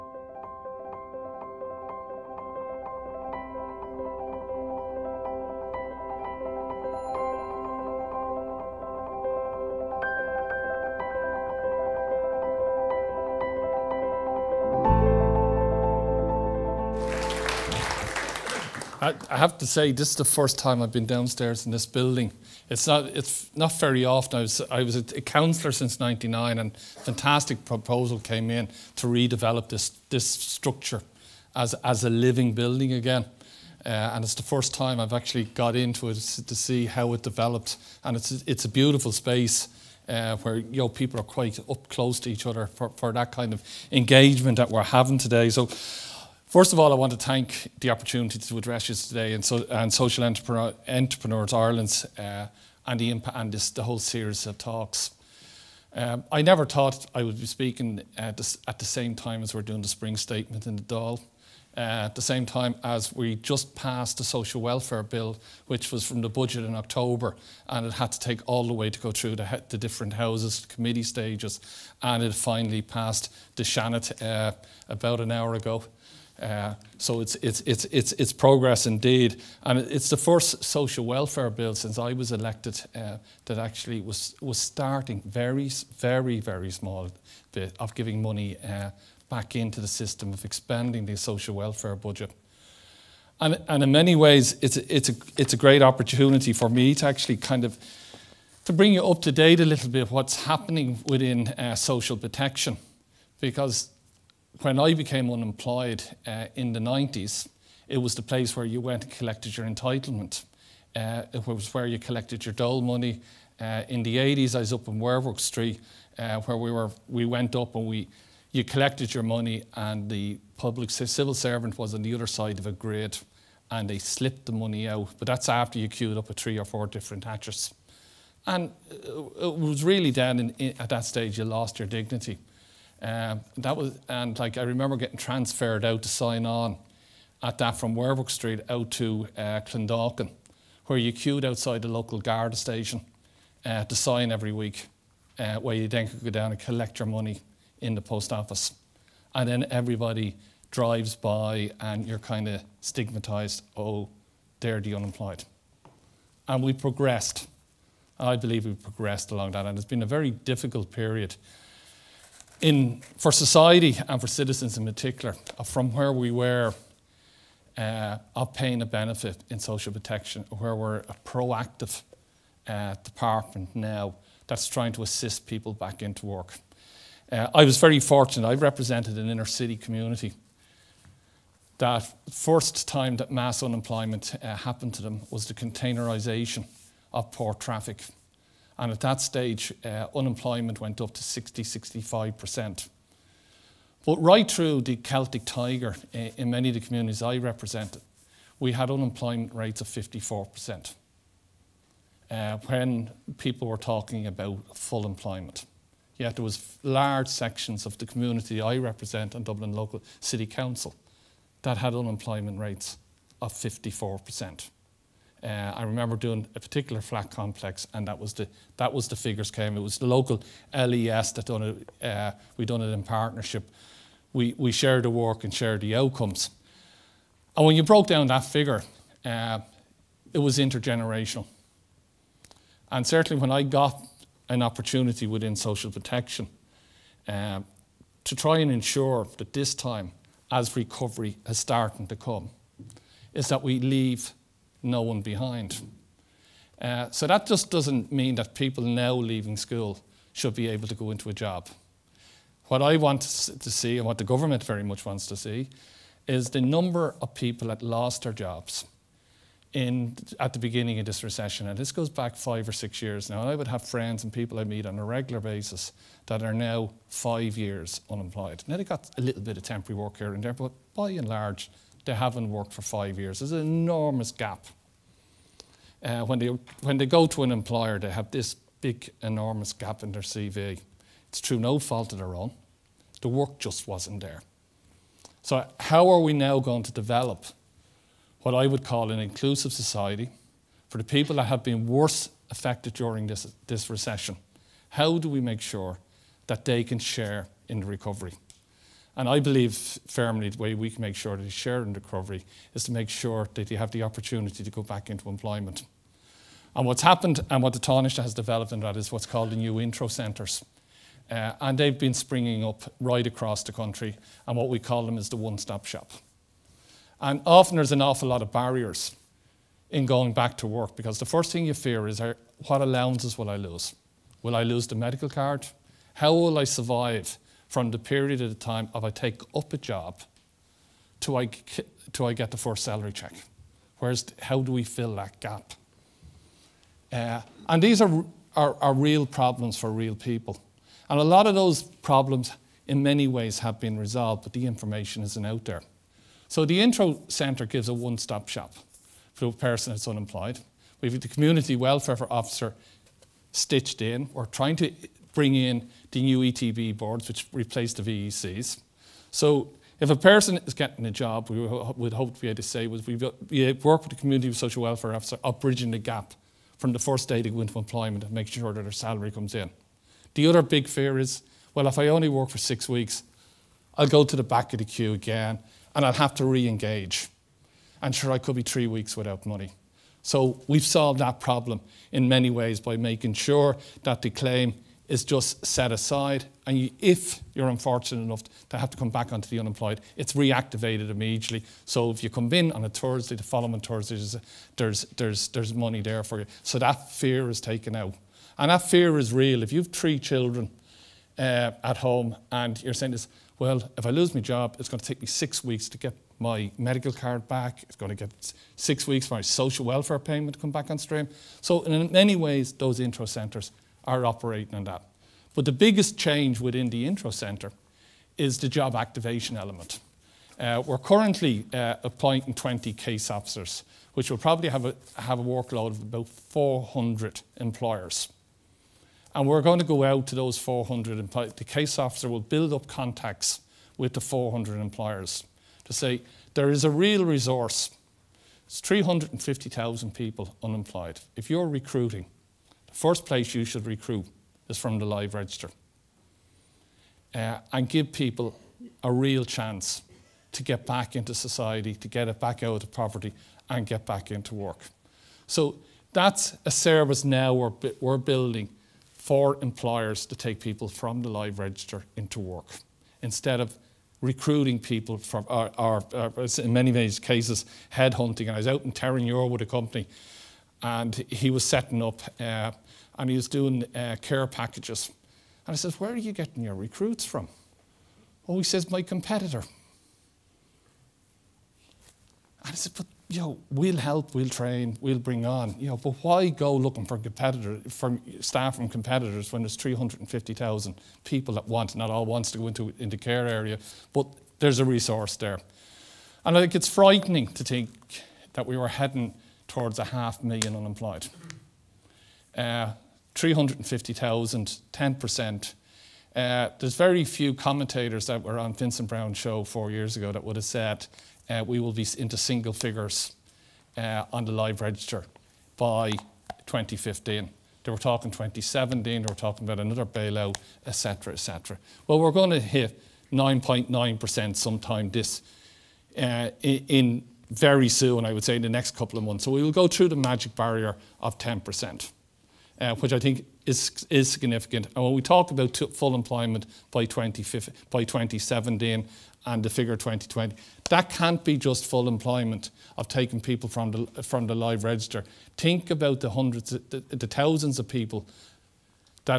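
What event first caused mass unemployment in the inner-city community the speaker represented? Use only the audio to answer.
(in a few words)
containerisation of port traffic.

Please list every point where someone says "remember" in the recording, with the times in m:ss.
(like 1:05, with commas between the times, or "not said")
2:14, 3:35.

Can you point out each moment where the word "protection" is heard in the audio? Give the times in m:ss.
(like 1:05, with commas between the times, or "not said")
1:42, 2:49, 3:55.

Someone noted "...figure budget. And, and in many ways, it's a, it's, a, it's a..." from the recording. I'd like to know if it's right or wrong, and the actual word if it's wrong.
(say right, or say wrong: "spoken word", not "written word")
wrong: "welfare", not "figure".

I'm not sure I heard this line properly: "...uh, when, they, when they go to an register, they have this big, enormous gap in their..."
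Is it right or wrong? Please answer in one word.
wrong.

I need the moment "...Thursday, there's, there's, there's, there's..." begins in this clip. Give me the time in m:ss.
6:33.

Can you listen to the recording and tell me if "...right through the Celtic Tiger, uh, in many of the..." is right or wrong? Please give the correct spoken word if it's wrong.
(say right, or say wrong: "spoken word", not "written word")
right.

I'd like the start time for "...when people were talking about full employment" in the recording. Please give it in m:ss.
3:22.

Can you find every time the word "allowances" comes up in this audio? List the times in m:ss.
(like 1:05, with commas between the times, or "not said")
5:22.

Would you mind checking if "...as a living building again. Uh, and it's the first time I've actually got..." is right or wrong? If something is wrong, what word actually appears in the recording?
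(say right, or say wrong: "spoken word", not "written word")
right.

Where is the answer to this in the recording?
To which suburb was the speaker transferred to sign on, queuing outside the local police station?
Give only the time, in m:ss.
2:19.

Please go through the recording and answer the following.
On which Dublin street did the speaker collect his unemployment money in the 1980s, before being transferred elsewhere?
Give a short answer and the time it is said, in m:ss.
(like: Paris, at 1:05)
Werwick Street, at 1:54.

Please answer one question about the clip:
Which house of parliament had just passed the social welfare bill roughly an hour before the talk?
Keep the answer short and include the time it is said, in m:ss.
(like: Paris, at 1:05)
Seanad, at 1:13.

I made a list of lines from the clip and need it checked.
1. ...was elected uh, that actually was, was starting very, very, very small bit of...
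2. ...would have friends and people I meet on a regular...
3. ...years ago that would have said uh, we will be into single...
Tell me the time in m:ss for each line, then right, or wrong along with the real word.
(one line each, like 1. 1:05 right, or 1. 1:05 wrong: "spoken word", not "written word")
1. 1:22 right
2. 4:23 right
3. 8:29 right.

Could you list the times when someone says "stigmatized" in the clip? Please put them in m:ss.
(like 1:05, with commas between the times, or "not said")
2:32.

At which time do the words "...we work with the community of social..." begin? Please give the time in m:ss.
6:03.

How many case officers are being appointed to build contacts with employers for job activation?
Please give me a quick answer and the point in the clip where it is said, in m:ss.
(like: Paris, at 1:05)
20, at 7:02.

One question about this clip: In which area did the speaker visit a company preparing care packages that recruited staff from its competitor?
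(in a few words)
Terenure.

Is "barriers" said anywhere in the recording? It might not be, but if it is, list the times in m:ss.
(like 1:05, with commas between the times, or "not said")
5:18, 8:50.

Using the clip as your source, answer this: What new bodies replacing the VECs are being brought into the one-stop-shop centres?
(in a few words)
ETB boards.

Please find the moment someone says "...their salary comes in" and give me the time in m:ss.
6:08.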